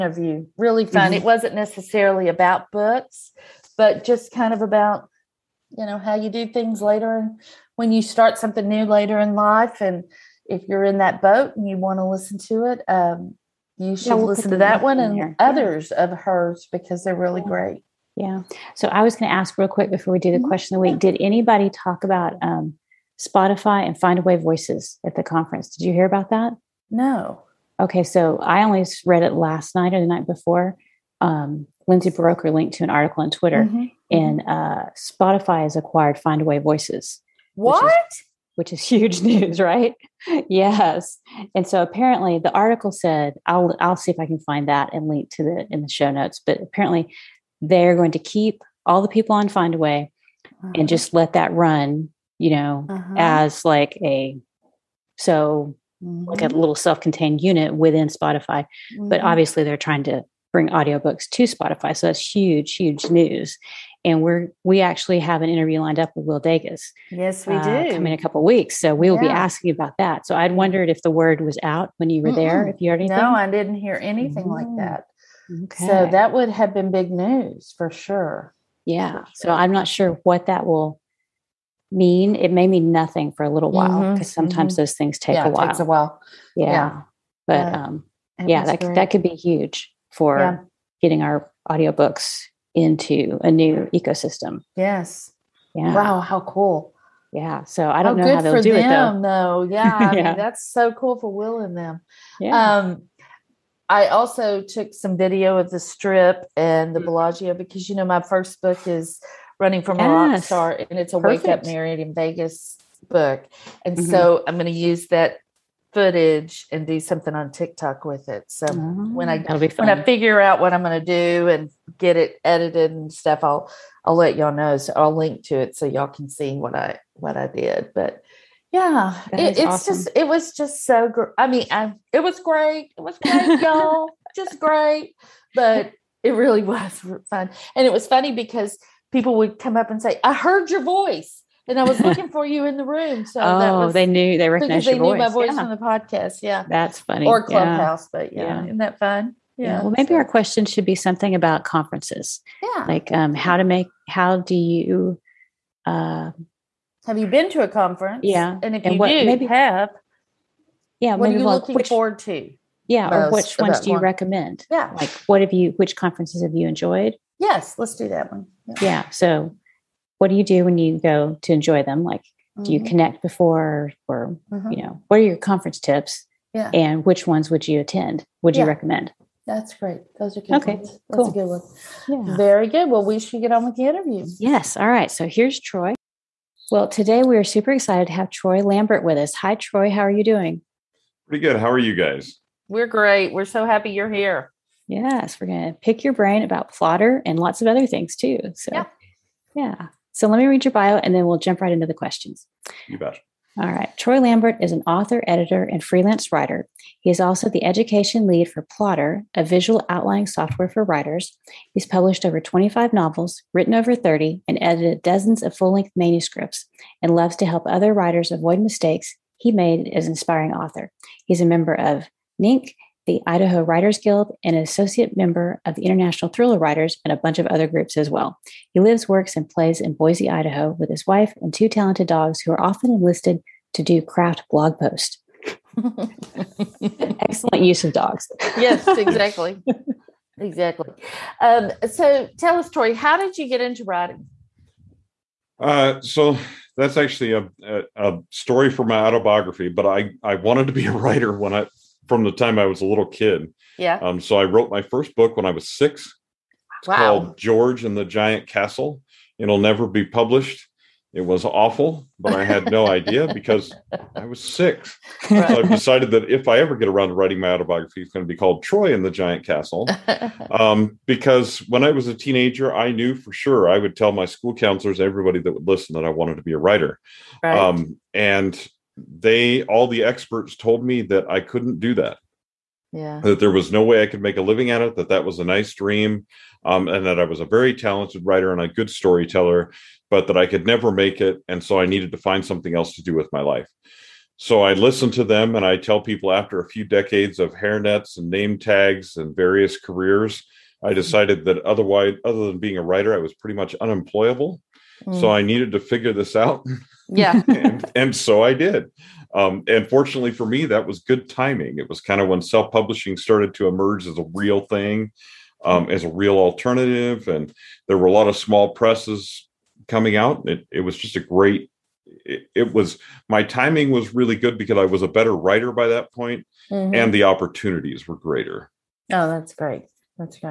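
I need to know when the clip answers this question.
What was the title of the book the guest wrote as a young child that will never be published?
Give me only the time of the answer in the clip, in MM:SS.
04:17.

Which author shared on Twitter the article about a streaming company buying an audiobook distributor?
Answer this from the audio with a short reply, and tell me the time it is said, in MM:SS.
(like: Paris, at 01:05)
Lindsay Buroker, at 00:31.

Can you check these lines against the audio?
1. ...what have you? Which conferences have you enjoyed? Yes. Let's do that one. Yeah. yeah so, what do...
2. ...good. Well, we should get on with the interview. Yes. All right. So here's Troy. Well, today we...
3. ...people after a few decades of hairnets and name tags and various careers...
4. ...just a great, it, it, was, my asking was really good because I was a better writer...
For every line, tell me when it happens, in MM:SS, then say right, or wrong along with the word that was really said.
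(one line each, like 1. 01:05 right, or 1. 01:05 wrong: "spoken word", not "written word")
1. 02:45 right
2. 03:02 right
3. 04:56 right
4. 05:20 wrong: "timing", not "asking".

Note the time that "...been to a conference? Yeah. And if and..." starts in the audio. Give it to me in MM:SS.
02:37.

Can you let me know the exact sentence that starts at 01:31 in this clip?
getting our audiobooks into a new ecosystem.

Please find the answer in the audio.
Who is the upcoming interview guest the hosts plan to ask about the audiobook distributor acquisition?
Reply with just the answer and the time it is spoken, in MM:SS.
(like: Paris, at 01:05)
Will Dages, at 01:06.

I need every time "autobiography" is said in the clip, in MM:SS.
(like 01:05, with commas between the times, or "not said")
04:08, 04:27.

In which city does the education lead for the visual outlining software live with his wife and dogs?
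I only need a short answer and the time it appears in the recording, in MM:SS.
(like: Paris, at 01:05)
Boise, Idaho, at 03:49.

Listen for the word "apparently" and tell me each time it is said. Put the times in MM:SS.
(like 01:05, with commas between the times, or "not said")
00:41, 00:46.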